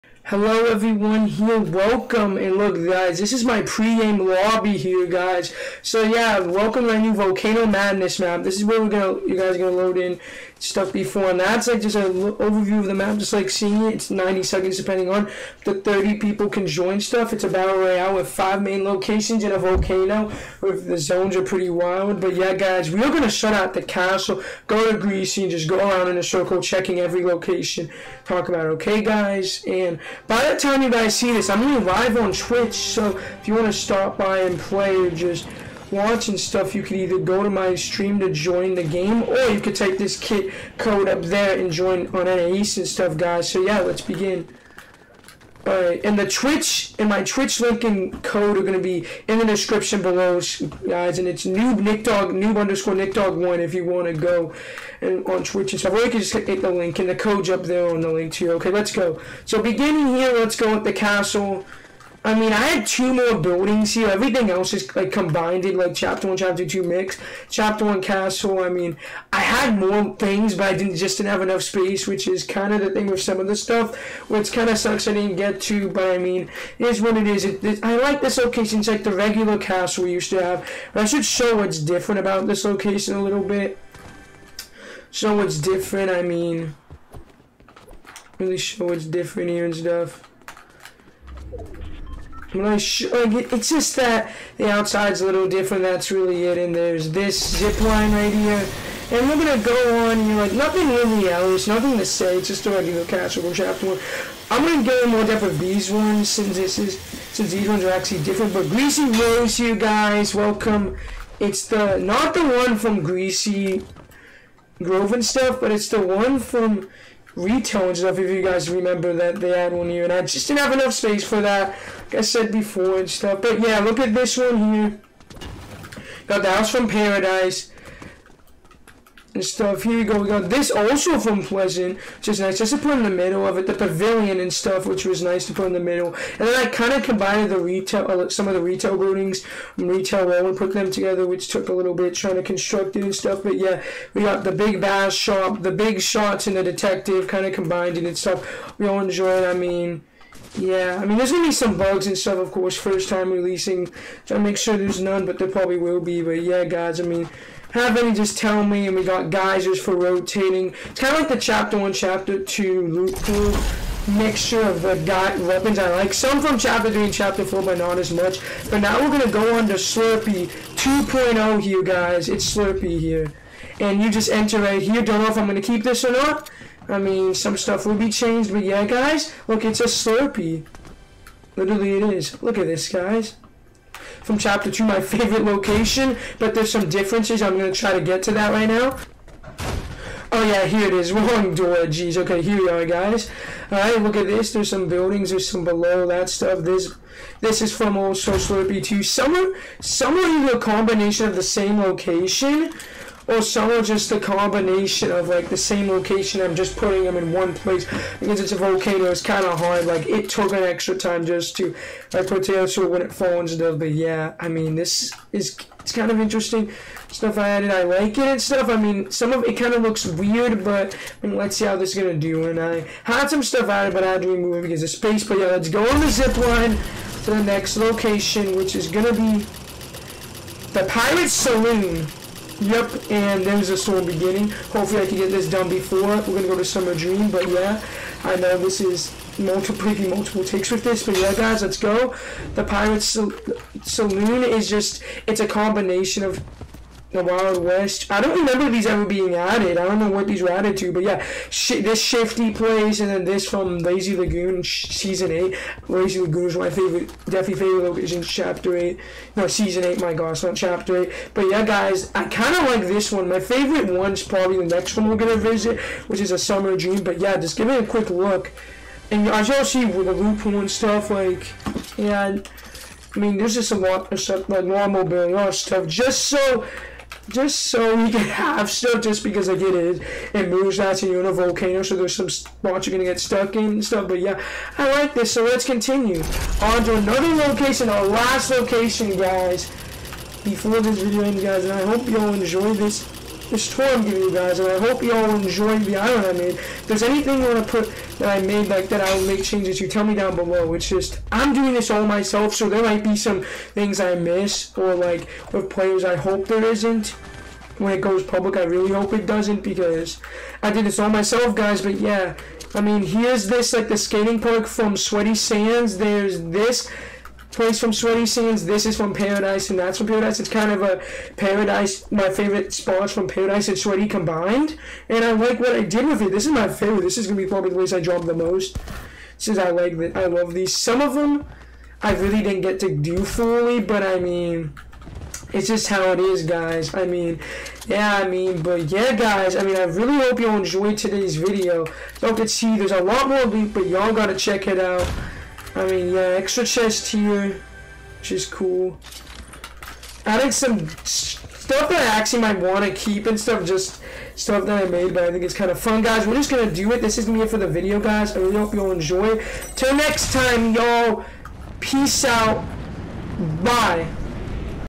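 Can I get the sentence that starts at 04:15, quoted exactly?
Lazy Lagoon is my favorite, definitely favorite location.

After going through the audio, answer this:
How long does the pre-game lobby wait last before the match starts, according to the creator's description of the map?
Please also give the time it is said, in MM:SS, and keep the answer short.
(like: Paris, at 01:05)
90 seconds, at 00:14.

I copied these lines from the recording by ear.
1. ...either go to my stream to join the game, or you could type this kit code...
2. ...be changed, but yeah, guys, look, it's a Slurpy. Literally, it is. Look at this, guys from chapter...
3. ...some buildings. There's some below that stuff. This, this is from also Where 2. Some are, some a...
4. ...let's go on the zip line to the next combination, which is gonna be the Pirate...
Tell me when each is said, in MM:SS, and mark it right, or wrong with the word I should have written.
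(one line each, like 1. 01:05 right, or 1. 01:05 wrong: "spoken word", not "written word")
1. 00:36 right
2. 02:57 right
3. 03:14 wrong: "Slurpy", not "Where"
4. 03:45 wrong: "location", not "combination".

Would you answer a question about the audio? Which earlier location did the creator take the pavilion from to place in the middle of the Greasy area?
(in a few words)
Pleasant.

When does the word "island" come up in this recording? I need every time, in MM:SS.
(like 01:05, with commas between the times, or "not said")
04:55.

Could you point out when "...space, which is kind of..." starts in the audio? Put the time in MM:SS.
01:11.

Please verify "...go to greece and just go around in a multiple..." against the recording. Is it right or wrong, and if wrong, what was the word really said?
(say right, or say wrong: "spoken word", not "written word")
wrong: "circle", not "multiple".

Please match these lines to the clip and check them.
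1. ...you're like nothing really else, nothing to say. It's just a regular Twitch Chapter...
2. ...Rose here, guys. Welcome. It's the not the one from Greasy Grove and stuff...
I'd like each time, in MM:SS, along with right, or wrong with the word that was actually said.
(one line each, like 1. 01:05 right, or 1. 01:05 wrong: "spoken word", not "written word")
1. 01:40 wrong: "Castle", not "Twitch"
2. 01:49 right.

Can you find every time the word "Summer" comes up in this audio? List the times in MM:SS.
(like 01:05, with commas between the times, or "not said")
03:56, 04:26.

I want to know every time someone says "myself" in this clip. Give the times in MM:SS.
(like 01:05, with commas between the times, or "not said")
05:02, 05:11.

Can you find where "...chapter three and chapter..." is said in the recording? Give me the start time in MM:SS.
02:46.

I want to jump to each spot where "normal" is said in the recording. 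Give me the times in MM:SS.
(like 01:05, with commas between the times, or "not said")
04:34.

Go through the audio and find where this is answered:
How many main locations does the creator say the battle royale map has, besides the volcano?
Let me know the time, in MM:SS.
00:18.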